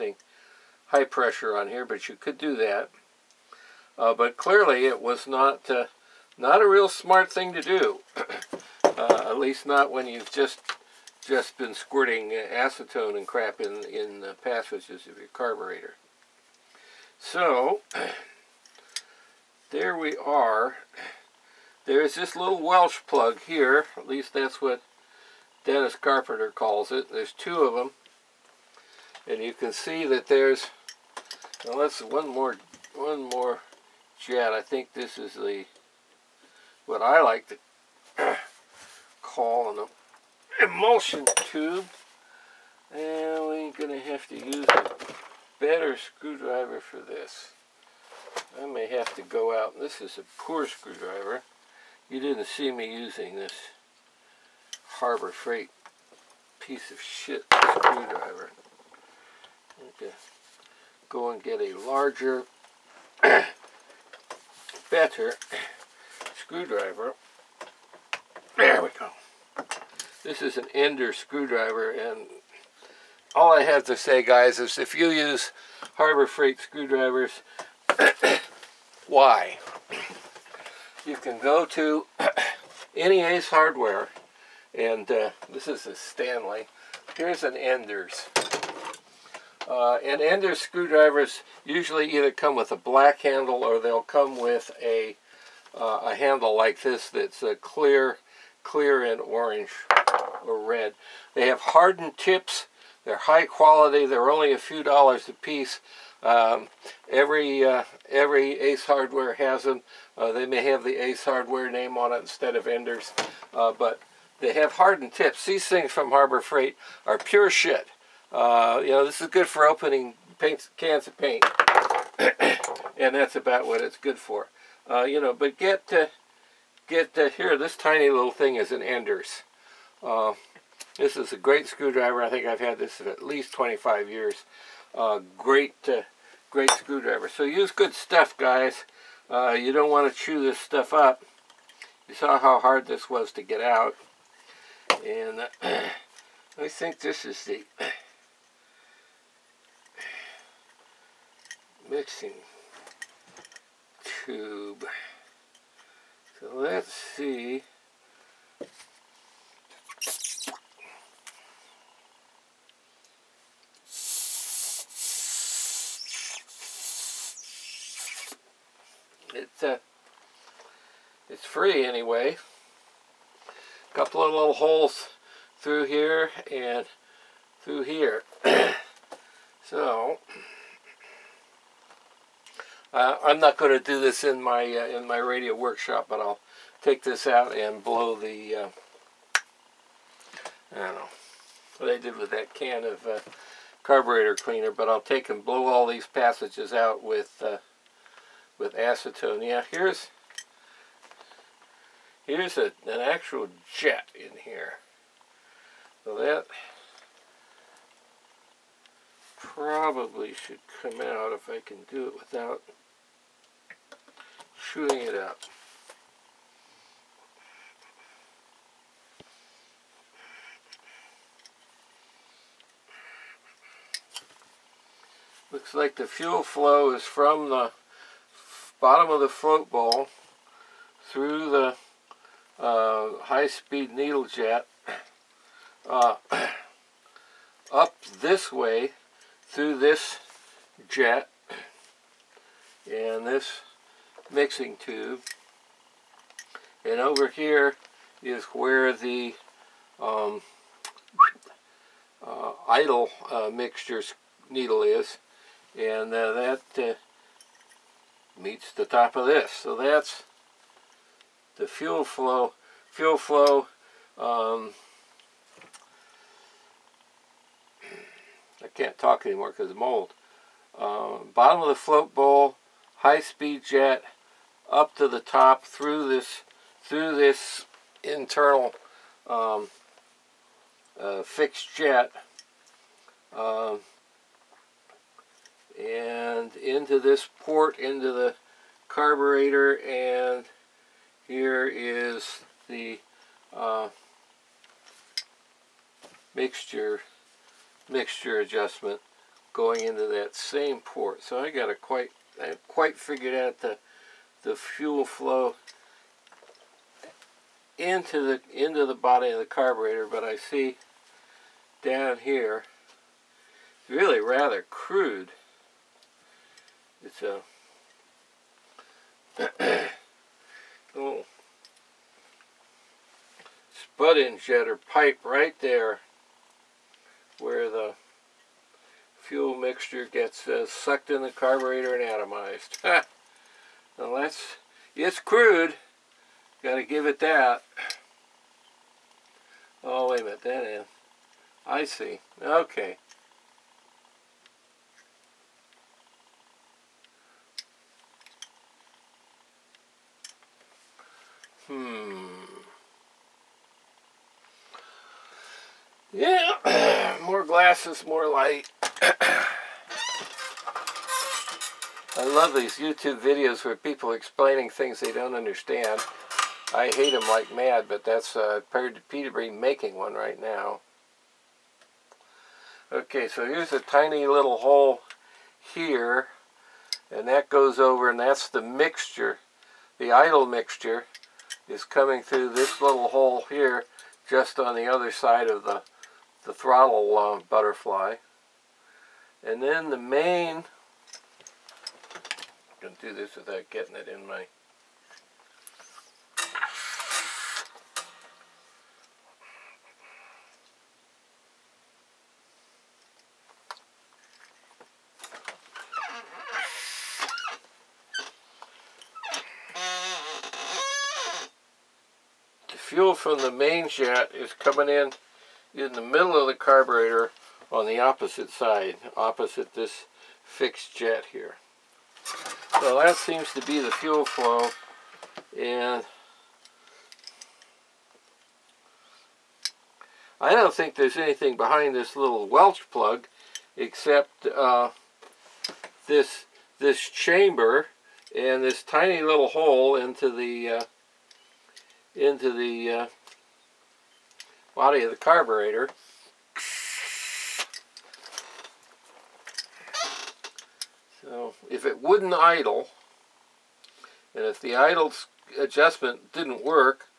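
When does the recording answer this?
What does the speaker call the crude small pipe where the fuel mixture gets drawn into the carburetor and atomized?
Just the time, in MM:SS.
05:23.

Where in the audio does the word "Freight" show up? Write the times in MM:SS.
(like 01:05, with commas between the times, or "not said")
00:55, 01:16, 01:56.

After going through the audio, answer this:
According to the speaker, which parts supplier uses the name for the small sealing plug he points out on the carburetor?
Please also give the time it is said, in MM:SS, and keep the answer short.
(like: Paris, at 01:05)
Dennis Carpenter, at 00:25.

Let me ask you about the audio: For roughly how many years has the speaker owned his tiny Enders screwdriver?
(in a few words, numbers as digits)
25 years.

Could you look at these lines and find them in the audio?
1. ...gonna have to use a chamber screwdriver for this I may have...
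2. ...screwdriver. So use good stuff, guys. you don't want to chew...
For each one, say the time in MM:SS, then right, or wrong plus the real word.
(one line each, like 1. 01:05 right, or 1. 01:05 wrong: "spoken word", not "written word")
1. 00:43 wrong: "better", not "chamber"
2. 02:16 right.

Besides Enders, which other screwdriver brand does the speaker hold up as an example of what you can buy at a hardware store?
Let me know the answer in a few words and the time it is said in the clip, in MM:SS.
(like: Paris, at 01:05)
Stanley, at 01:25.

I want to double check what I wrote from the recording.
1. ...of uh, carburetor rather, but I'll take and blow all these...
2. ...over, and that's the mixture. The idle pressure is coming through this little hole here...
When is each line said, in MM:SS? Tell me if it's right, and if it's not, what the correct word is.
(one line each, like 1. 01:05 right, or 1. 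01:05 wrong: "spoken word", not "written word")
1. 03:12 wrong: "cleaner", not "rather"
2. 06:17 wrong: "mixture", not "pressure".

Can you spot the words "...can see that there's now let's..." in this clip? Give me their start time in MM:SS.
00:29.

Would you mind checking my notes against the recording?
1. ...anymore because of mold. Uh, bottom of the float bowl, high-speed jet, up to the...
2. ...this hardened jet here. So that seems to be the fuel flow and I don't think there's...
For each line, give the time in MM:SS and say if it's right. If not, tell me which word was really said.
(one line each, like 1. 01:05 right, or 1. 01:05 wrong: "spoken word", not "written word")
1. 04:29 right
2. 06:59 wrong: "fixed", not "hardened".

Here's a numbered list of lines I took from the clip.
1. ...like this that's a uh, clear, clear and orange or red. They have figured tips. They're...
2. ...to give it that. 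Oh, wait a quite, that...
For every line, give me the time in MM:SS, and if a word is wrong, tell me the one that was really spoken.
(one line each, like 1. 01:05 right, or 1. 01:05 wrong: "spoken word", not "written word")
1. 01:36 wrong: "hardened", not "figured"
2. 05:36 wrong: "minute", not "quite".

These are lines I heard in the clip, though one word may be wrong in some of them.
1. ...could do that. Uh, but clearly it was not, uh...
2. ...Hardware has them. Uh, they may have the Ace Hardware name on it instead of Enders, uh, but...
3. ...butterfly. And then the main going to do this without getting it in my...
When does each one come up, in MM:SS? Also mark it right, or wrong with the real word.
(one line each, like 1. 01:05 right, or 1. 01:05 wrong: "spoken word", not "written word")
1. 00:02 right
2. 01:48 right
3. 06:27 right.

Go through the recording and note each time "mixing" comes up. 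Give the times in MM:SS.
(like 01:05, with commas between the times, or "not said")
02:31, 04:04.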